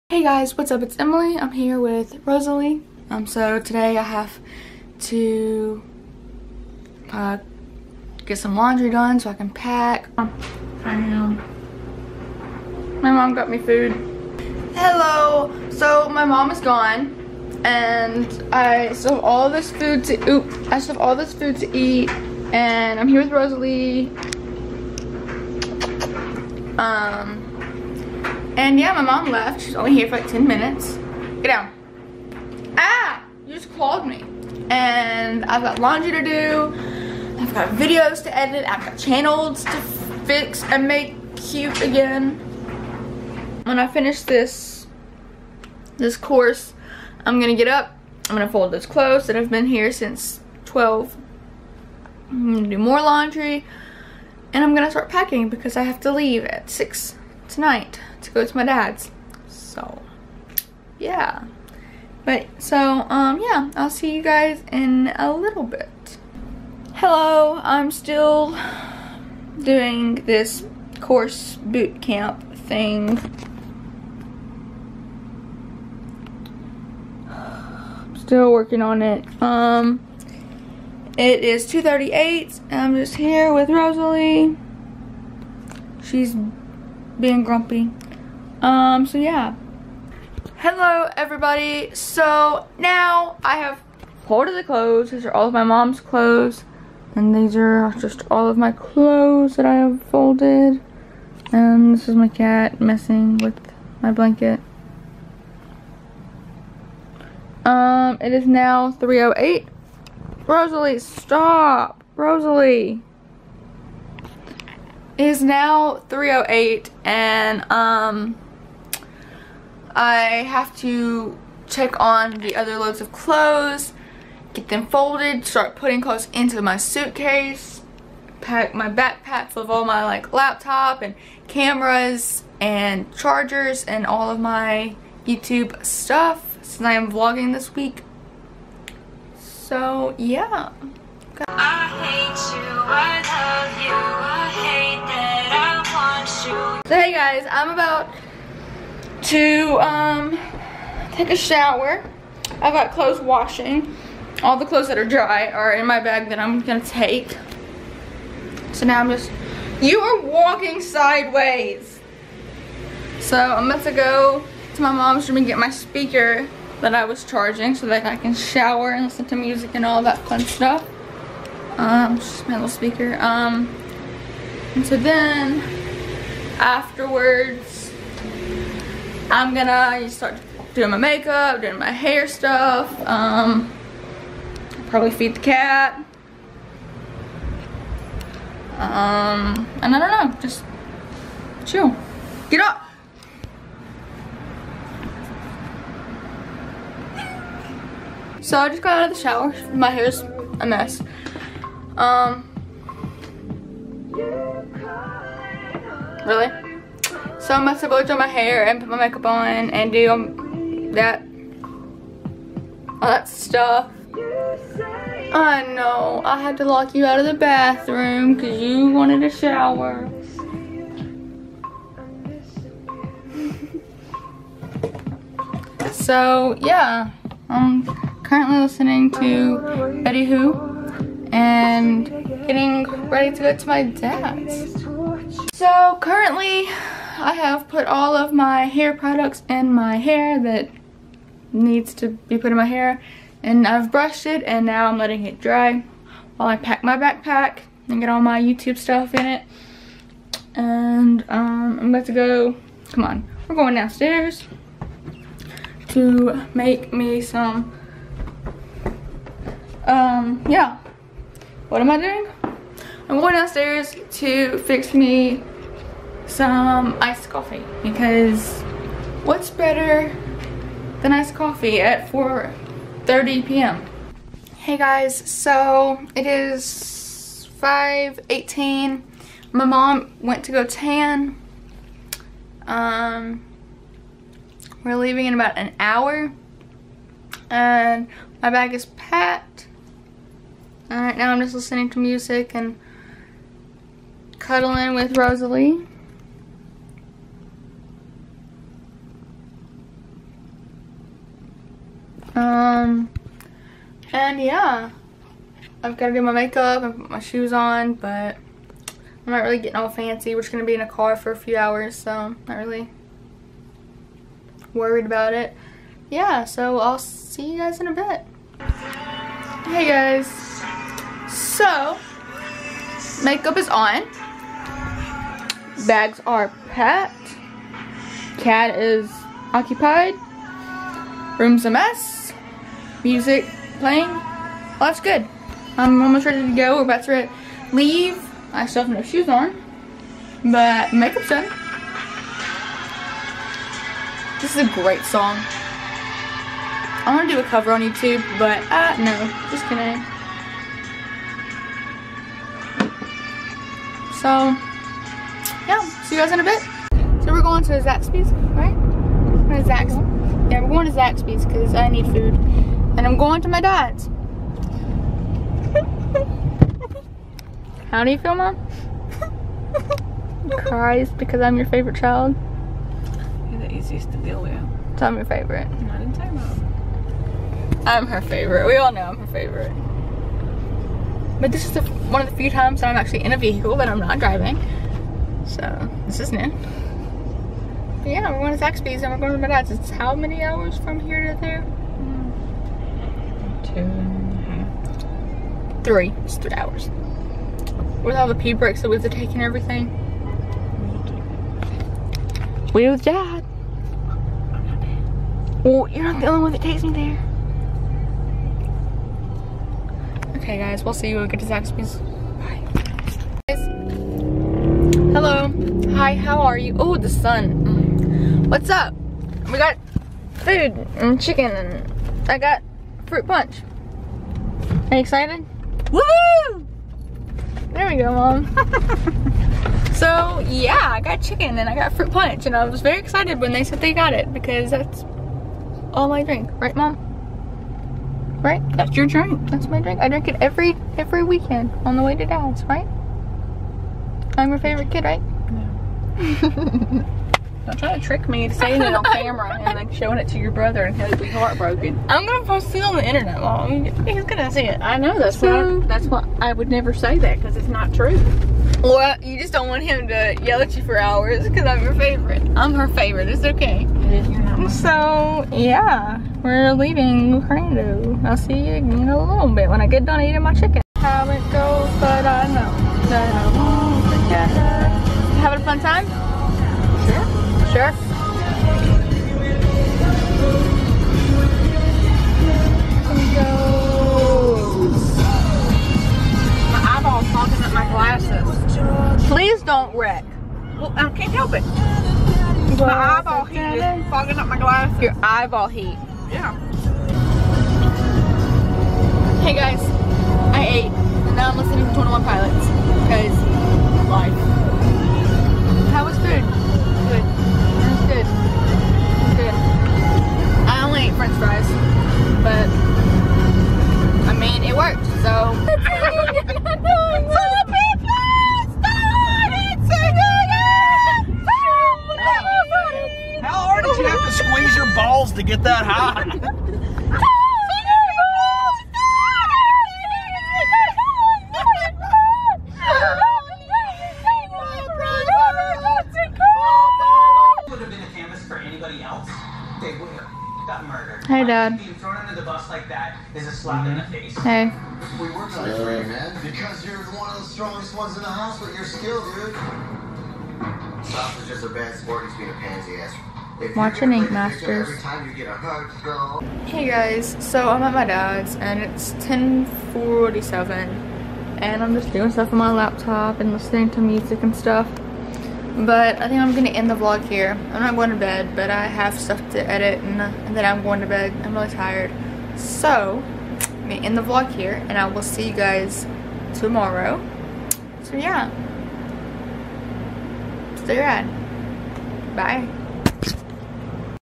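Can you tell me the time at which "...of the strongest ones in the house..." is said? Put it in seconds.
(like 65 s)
547 s.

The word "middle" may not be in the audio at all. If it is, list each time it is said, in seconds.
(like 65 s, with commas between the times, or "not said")
not said.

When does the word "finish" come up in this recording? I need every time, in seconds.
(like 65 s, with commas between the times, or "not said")
43 s.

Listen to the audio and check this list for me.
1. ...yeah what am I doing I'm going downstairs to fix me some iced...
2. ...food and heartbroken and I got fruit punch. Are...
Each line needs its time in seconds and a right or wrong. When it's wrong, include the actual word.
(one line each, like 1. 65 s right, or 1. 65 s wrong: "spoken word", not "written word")
1. 260 s right
2. 420 s wrong: "chicken", not "heartbroken".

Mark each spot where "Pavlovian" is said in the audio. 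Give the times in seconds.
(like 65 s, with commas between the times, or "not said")
not said.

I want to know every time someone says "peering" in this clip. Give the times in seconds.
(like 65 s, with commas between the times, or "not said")
not said.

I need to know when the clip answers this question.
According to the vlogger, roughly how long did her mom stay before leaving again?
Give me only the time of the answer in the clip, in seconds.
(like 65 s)
30 s.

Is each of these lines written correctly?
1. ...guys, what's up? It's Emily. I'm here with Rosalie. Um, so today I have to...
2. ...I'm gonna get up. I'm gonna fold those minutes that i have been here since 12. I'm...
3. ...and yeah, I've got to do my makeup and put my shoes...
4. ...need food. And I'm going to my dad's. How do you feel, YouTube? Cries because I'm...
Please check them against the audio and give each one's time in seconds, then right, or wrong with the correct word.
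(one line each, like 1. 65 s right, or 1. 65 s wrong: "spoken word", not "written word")
1. 0 s right
2. 47 s wrong: "clothes", not "minutes"
3. 304 s right
4. 361 s wrong: "Mom", not "YouTube".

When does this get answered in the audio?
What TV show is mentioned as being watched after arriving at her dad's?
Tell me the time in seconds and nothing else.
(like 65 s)
554 s.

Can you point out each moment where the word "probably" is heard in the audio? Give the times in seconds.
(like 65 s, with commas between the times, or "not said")
184 s.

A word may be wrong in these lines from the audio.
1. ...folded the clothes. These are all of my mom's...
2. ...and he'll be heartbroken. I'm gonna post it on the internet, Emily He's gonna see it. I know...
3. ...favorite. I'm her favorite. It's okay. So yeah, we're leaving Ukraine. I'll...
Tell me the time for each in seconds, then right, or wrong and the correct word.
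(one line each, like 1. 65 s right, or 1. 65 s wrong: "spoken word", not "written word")
1. 94 s right
2. 450 s wrong: "Long", not "Emily"
3. 461 s right.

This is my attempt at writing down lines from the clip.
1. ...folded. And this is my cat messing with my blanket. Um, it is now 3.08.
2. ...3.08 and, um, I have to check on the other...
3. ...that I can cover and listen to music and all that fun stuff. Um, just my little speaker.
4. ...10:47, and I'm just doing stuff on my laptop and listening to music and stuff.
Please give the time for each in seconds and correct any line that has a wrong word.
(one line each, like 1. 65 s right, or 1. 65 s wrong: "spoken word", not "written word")
1. 100 s right
2. 116 s right
3. 167 s wrong: "shower", not "cover"
4. 559 s right.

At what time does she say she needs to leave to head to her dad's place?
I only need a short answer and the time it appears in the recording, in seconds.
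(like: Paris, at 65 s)
6, at 56 s.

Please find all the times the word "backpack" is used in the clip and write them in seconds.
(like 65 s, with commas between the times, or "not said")
128 s, 246 s.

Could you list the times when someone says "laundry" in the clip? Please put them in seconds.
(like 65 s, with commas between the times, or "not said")
8 s, 35 s, 53 s.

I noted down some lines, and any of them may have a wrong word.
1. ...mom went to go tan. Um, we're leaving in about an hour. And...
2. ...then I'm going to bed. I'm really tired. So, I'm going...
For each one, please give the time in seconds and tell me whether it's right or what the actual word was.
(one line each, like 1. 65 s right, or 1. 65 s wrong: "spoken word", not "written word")
1. 279 s right
2. 570 s right.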